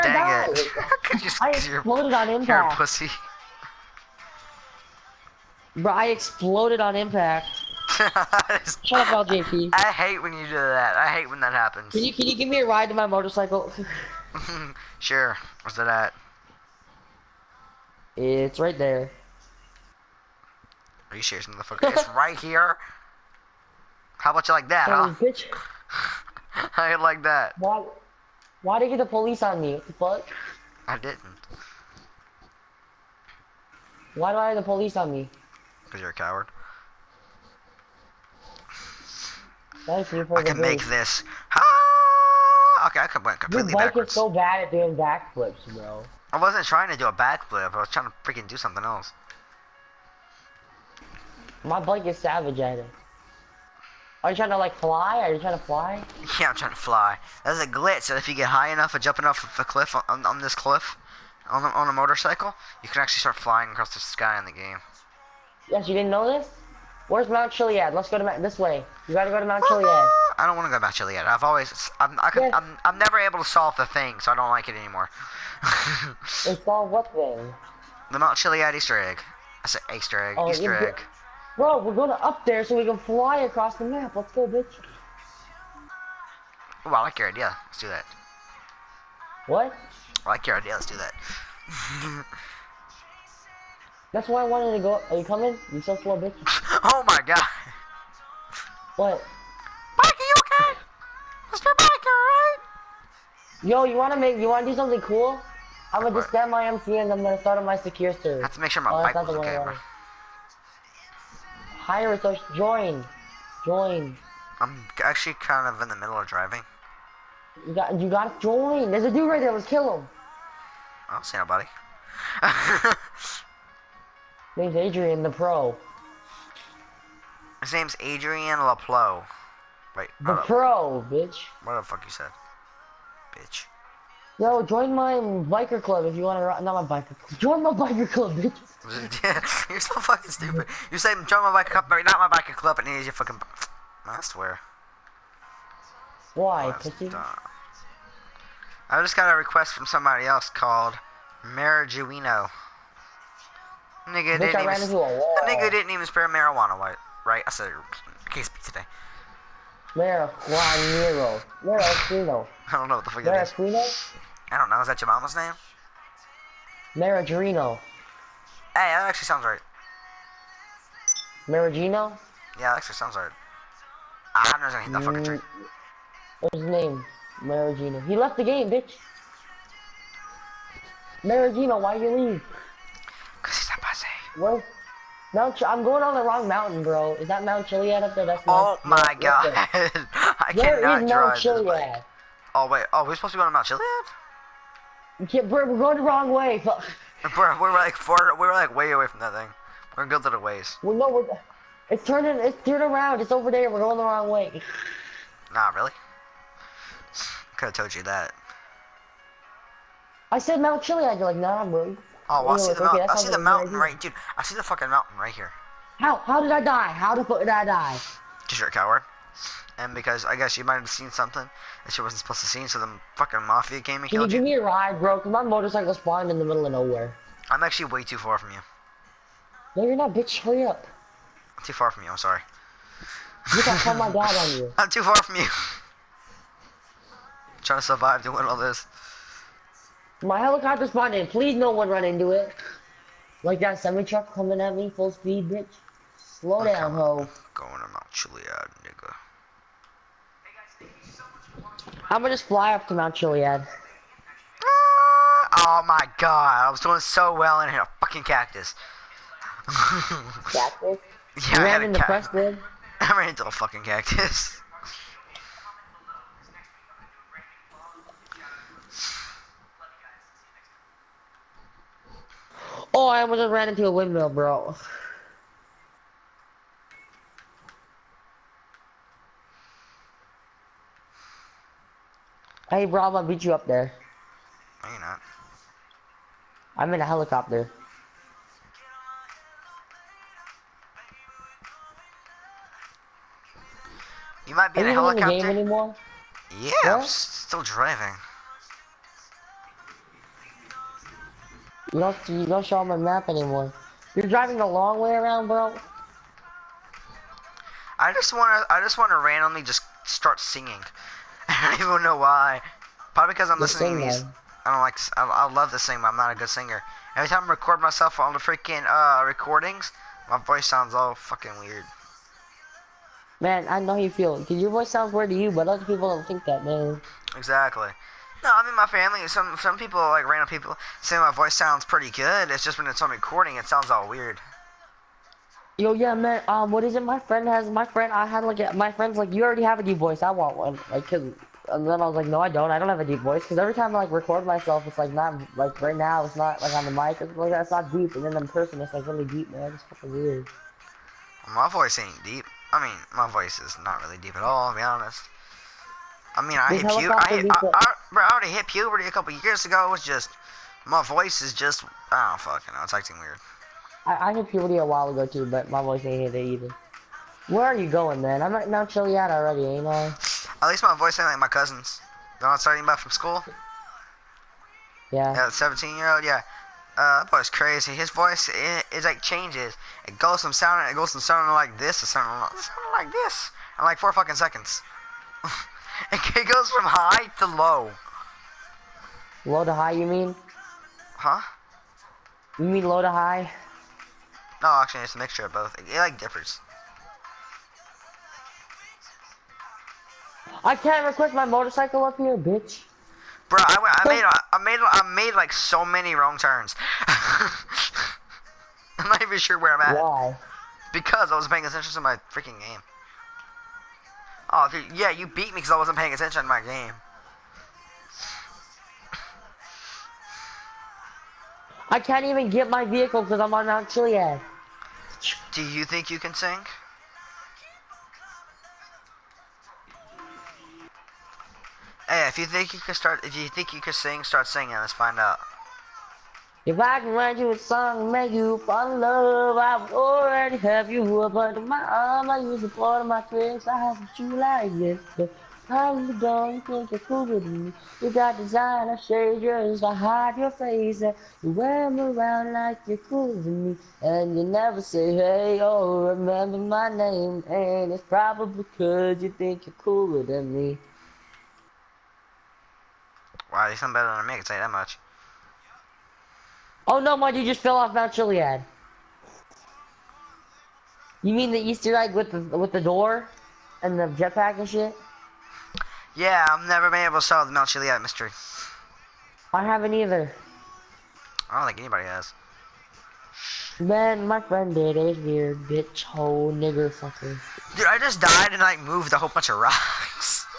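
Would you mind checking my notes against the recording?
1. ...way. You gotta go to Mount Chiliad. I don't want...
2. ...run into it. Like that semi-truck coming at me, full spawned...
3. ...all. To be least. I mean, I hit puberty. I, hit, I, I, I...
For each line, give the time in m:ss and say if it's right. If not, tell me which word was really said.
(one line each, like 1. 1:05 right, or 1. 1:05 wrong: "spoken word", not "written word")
1. 1:08 right
2. 4:01 wrong: "speed", not "spawned"
3. 5:54 wrong: "honest", not "least".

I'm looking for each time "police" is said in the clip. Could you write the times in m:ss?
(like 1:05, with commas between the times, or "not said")
0:29, 0:34.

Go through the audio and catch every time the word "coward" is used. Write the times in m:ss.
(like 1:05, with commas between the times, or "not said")
0:36, 3:38.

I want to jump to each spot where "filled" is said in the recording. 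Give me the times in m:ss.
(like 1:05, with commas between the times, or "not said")
not said.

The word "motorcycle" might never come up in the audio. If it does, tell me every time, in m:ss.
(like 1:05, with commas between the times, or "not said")
0:13, 1:01, 3:45, 6:41.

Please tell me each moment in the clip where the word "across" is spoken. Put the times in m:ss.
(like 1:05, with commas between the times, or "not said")
1:03, 1:23.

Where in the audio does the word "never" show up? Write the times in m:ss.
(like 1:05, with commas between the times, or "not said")
1:12, 7:34, 7:56.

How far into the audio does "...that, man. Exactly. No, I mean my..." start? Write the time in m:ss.
5:26.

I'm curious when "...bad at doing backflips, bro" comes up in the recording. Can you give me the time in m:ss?
0:44.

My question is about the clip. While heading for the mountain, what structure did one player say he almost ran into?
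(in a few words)
Windmill.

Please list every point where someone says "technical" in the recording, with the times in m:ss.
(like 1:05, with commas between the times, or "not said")
not said.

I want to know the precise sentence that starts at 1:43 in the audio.
Yo, you wanna make, you wanna do something cool?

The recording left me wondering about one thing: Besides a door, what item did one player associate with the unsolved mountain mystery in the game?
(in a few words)
Jetpack.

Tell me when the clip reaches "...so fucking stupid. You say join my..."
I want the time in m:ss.
2:19.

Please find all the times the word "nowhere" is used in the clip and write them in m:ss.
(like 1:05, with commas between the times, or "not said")
3:46.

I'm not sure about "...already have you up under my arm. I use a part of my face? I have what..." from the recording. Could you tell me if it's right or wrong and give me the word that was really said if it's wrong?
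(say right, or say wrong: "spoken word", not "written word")
right.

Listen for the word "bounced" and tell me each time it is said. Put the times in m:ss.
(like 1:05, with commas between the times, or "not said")
not said.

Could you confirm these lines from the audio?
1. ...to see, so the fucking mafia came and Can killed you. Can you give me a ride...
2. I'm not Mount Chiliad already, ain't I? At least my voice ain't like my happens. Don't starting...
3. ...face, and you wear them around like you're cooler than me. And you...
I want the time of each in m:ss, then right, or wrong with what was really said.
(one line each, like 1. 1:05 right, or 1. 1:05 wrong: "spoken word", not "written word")
1. 3:42 right
2. 6:08 wrong: "cousins", not "happens"
3. 7:30 right.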